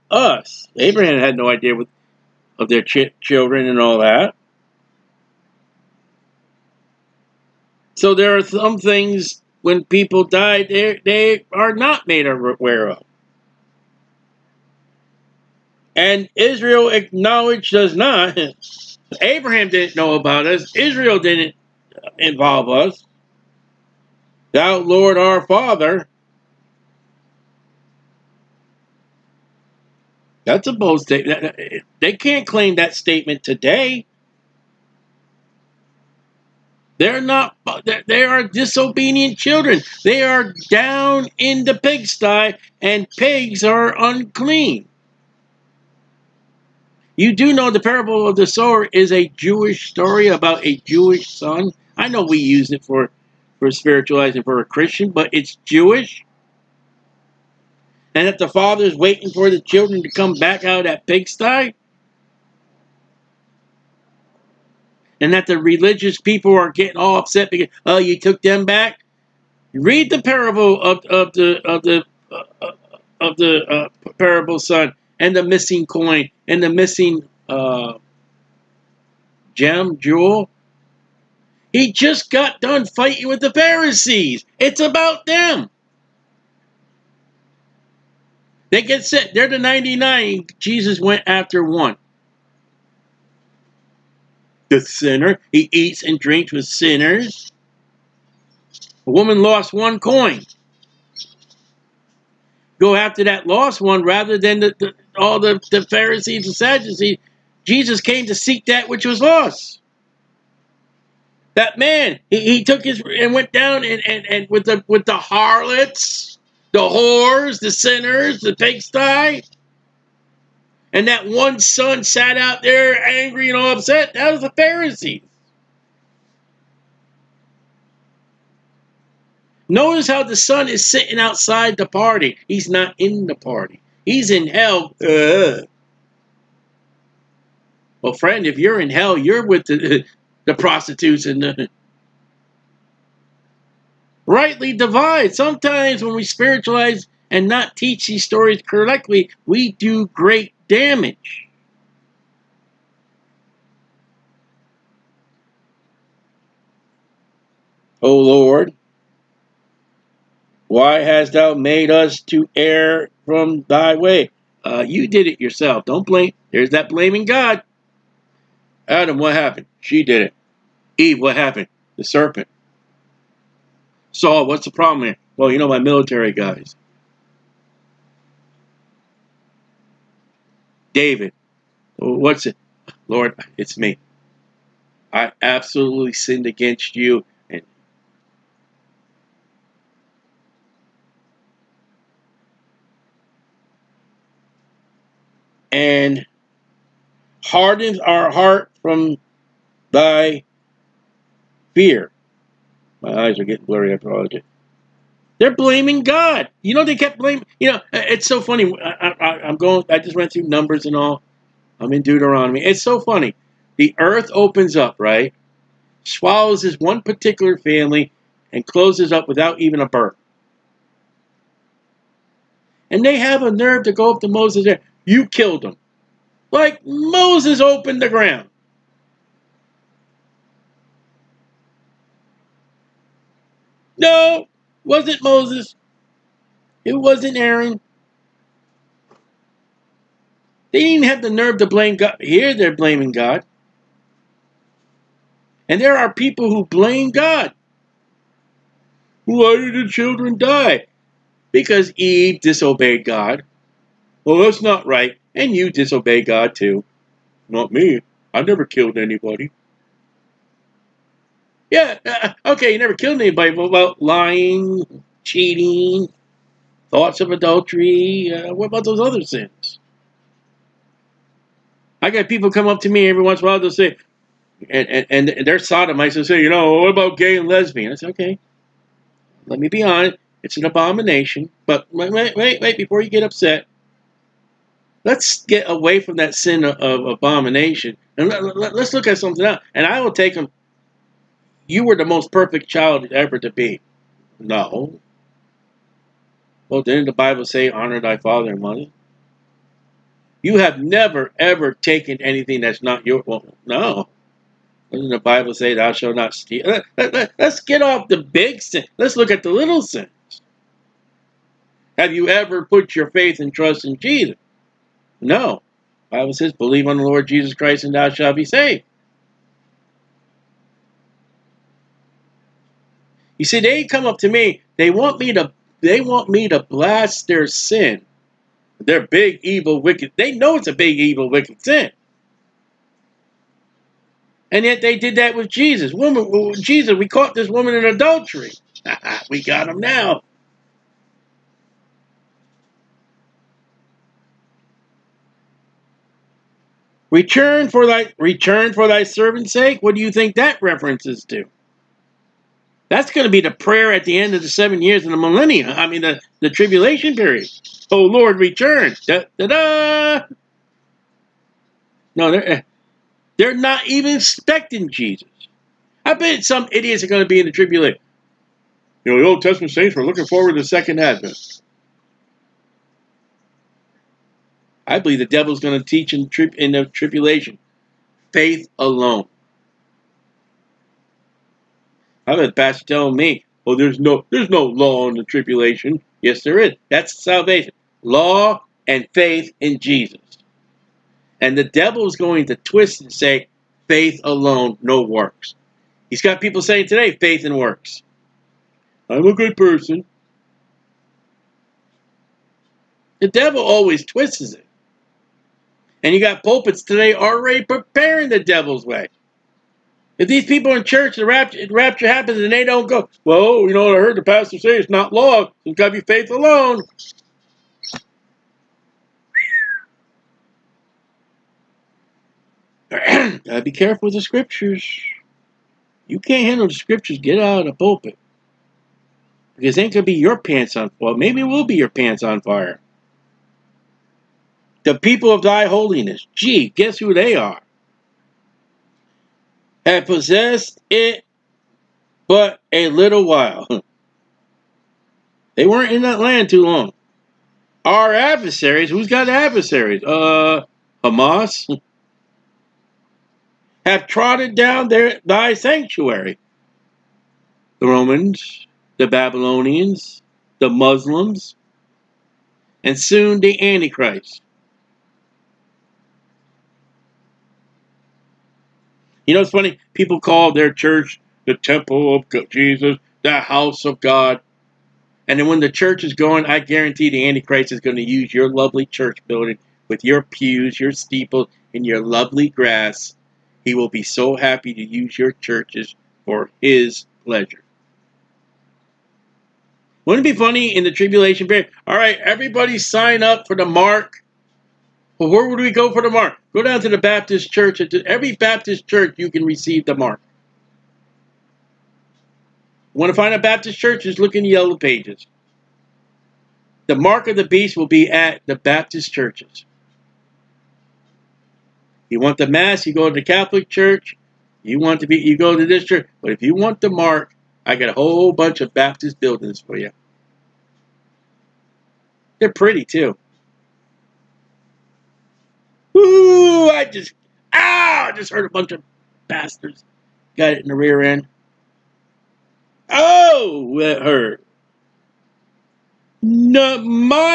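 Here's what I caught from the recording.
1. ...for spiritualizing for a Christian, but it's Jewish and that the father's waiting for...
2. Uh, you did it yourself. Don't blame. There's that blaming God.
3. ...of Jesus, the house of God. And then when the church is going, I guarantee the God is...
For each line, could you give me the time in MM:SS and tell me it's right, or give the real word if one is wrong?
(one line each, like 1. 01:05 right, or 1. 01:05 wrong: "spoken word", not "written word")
1. 00:53 right
2. 02:44 right
3. 07:52 wrong: "Antichrist", not "God".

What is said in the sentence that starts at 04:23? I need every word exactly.
What about lying, cheating, thoughts of adultery?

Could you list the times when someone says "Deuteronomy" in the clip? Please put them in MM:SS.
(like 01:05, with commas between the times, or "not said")
03:32.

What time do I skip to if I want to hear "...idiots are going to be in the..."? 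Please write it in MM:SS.
06:06.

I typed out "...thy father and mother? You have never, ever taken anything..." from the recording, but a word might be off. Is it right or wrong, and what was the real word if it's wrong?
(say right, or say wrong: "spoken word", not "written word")
right.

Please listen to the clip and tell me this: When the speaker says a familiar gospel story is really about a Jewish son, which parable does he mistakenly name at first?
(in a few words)
The parable of the sower.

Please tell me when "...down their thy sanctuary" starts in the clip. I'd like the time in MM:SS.
07:34.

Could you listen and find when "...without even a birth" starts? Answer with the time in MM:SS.
03:39.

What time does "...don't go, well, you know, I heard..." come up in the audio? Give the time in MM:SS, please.
06:52.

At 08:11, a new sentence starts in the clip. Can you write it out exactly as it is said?
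All right, everybody sign up for the mark but where would we go for the mark?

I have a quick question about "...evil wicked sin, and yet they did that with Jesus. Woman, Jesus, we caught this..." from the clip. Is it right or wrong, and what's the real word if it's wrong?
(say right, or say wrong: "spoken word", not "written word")
right.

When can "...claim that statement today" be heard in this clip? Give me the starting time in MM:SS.
00:32.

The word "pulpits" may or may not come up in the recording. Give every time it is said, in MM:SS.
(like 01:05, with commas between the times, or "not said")
06:46, 07:07.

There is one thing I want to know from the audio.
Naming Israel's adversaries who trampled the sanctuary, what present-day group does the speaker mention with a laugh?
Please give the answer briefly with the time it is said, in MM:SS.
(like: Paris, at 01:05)
Hamas, at 07:31.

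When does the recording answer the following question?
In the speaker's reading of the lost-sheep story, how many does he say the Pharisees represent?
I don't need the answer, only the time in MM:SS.
01:29.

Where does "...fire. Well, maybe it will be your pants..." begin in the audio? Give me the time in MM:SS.
07:10.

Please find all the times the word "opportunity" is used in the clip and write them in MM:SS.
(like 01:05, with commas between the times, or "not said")
not said.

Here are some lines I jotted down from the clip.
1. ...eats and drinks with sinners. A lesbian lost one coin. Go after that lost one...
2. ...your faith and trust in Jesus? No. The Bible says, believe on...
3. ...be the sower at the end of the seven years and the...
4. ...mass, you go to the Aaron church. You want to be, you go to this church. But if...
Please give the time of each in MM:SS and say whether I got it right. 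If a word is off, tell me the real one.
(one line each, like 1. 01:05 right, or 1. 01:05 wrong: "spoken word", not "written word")
1. 01:35 wrong: "woman", not "lesbian"
2. 05:12 right
3. 05:53 wrong: "prayer", not "sower"
4. 08:32 wrong: "Catholic", not "Aaron".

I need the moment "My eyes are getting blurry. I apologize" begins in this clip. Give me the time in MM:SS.
03:23.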